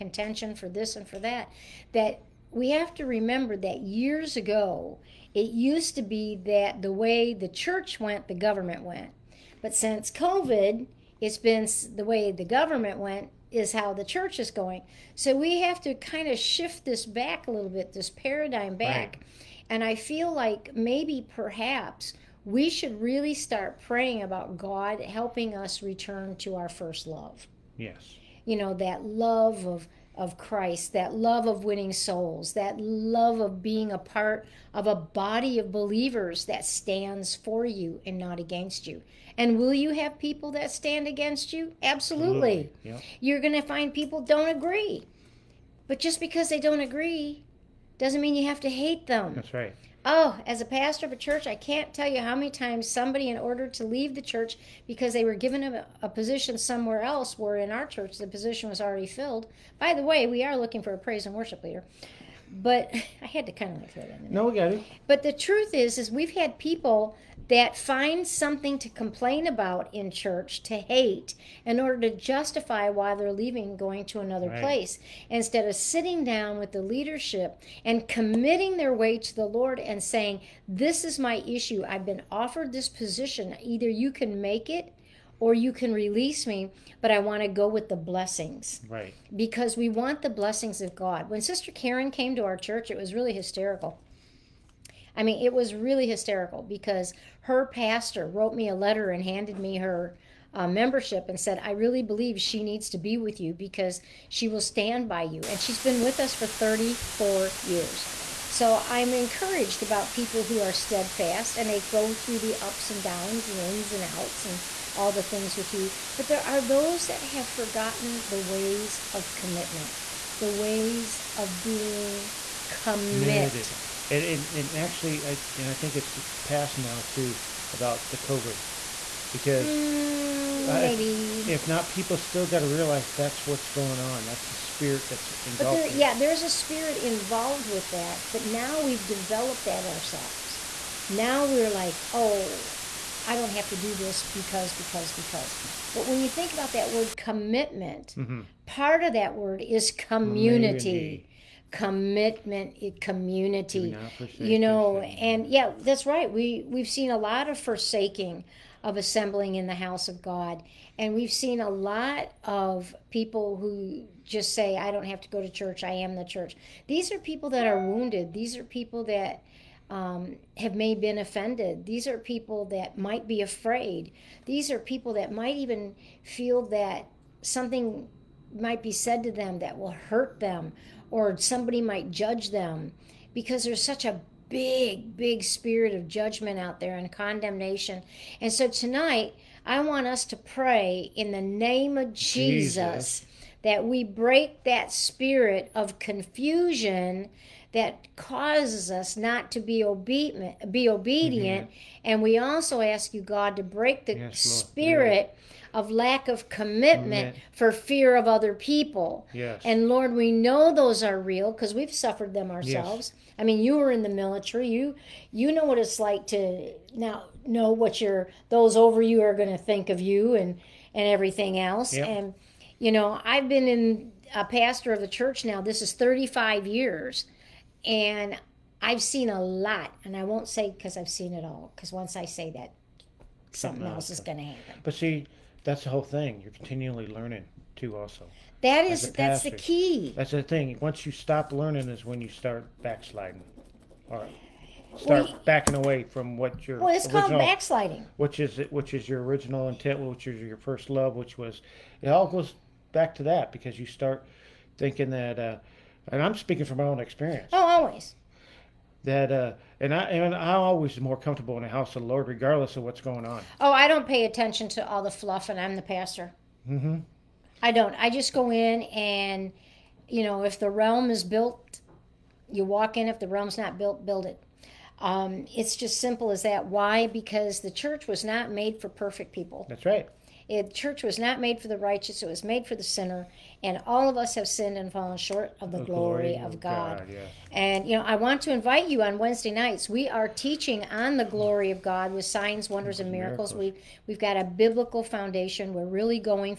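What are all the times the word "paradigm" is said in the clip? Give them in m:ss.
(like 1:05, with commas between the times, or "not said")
0:18.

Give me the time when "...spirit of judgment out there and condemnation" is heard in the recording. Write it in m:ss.
3:05.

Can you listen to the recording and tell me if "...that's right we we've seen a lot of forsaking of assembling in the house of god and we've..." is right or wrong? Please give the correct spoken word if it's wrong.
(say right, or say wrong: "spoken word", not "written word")
right.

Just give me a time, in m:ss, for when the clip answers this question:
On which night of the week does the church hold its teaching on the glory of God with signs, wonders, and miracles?
4:49.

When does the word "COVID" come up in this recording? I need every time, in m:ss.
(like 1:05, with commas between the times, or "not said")
0:10, 2:08.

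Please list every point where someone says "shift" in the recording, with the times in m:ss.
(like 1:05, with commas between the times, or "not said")
0:16.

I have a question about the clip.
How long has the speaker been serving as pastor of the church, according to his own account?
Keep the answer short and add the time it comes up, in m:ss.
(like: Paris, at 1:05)
35 years, at 3:45.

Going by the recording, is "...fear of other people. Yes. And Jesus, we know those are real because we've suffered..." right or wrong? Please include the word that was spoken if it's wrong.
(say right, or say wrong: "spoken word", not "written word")
wrong: "Lord", not "Jesus".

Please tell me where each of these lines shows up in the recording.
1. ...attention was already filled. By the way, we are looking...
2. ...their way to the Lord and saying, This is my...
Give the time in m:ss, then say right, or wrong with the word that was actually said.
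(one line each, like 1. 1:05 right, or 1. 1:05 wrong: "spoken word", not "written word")
1. 0:58 wrong: "position", not "attention"
2. 1:18 right.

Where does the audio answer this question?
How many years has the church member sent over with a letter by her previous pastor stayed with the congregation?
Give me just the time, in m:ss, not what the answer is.
1:46.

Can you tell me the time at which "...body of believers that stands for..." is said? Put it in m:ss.
0:34.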